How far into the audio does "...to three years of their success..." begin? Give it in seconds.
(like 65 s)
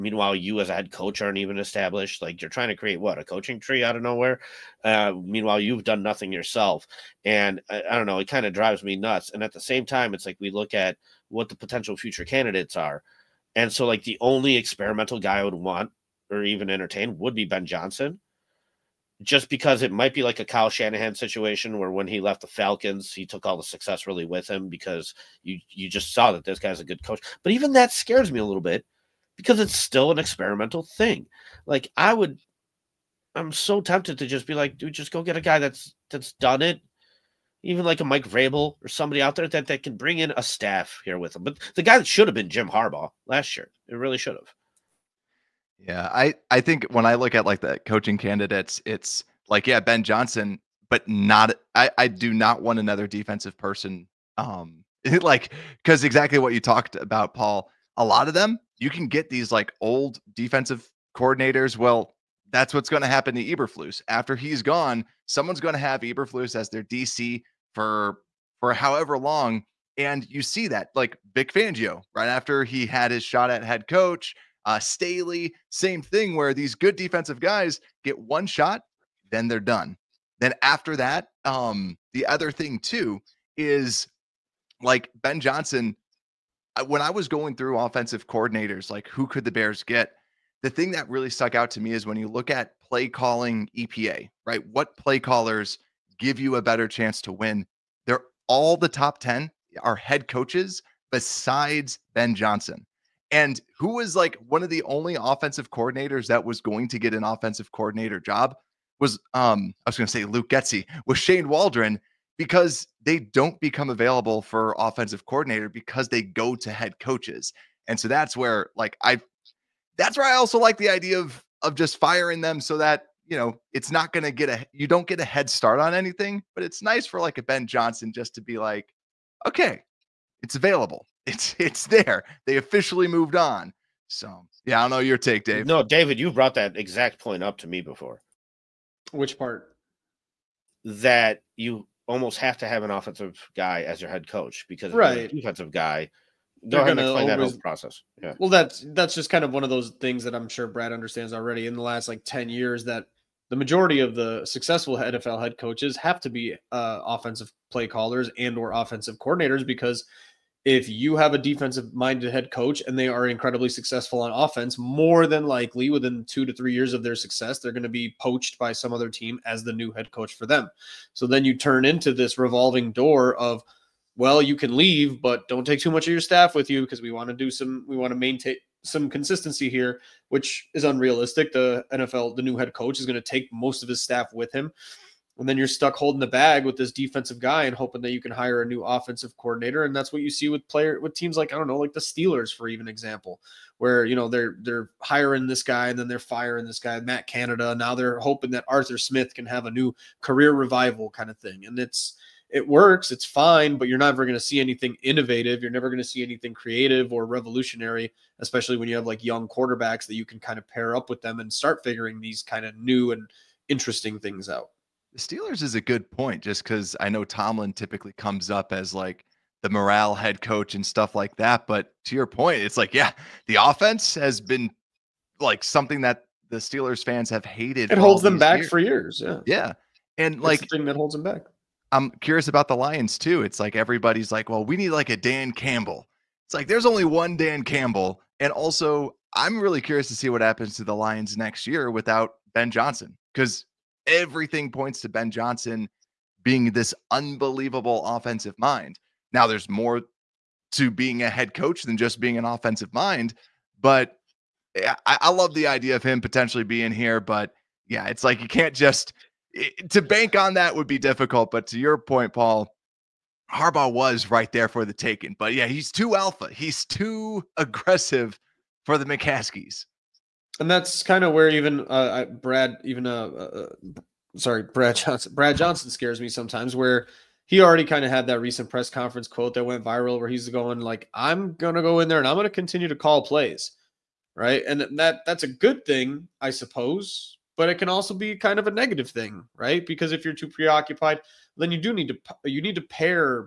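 166 s.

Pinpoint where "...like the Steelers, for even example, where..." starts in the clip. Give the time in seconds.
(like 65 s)
191 s.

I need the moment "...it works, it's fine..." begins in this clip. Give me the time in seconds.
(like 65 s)
202 s.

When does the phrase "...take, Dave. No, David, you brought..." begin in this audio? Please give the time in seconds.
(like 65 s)
135 s.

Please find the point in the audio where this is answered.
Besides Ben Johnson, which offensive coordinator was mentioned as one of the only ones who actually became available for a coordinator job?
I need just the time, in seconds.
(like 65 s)
111 s.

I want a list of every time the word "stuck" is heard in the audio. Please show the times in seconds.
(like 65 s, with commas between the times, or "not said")
91 s, 185 s.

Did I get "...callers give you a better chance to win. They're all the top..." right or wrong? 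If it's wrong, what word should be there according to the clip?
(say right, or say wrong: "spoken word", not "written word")
right.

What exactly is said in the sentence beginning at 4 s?
Uh, meanwhile, you've done nothing yourself, and I, I don't know.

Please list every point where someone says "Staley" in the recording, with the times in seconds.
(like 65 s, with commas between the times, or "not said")
74 s.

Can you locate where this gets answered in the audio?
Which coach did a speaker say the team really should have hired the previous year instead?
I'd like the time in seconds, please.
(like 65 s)
42 s.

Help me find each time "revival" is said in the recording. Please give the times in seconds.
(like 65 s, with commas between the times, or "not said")
200 s.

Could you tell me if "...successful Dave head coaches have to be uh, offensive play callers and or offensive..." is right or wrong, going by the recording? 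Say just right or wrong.
wrong.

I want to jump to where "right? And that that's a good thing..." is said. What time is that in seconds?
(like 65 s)
284 s.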